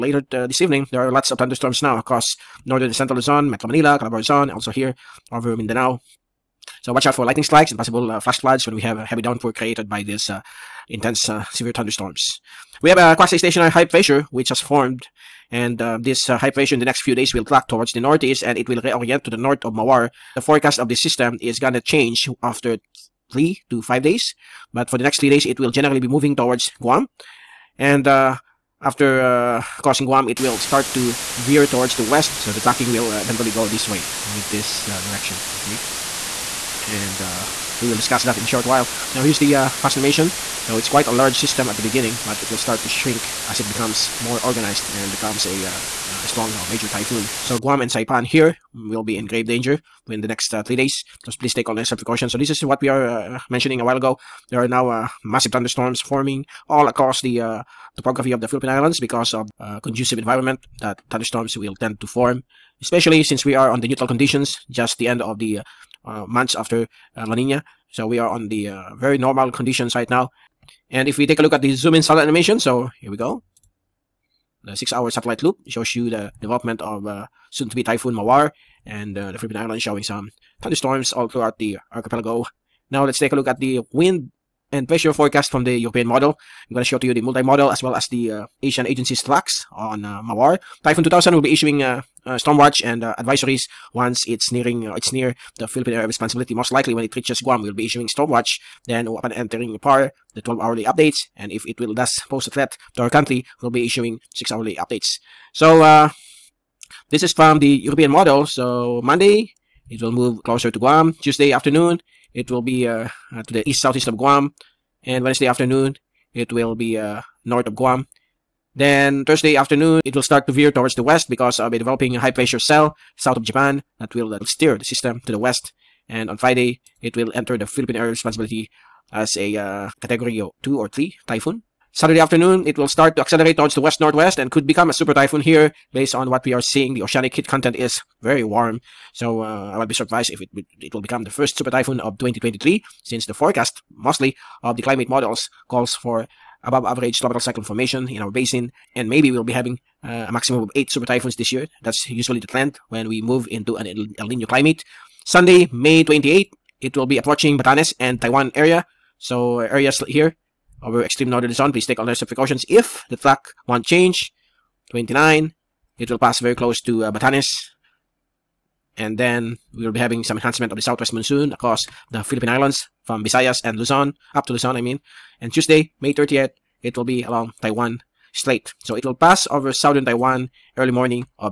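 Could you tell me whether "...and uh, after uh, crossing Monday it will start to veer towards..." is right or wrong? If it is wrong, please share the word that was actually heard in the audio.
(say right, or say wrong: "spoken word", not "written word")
wrong: "Guam", not "Monday".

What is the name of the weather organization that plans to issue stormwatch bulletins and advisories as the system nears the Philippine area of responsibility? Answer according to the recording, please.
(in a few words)
Typhoon 2000.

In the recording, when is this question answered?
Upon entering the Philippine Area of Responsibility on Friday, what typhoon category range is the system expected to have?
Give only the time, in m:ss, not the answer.
2:10.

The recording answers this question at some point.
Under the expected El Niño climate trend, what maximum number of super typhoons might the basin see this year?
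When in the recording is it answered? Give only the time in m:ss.
2:30.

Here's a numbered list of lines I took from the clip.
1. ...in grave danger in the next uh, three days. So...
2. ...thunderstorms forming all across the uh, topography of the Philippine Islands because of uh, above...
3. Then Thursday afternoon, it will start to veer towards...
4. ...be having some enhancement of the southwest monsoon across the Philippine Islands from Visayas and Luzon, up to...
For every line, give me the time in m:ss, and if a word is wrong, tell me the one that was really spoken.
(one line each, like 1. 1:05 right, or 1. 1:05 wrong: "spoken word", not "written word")
1. 0:49 right
2. 0:55 wrong: "conducive", not "above"
3. 1:58 right
4. 2:49 right.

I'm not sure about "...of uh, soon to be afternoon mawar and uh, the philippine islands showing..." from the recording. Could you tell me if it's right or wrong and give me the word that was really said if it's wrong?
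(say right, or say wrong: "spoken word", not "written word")
wrong: "typhoon", not "afternoon".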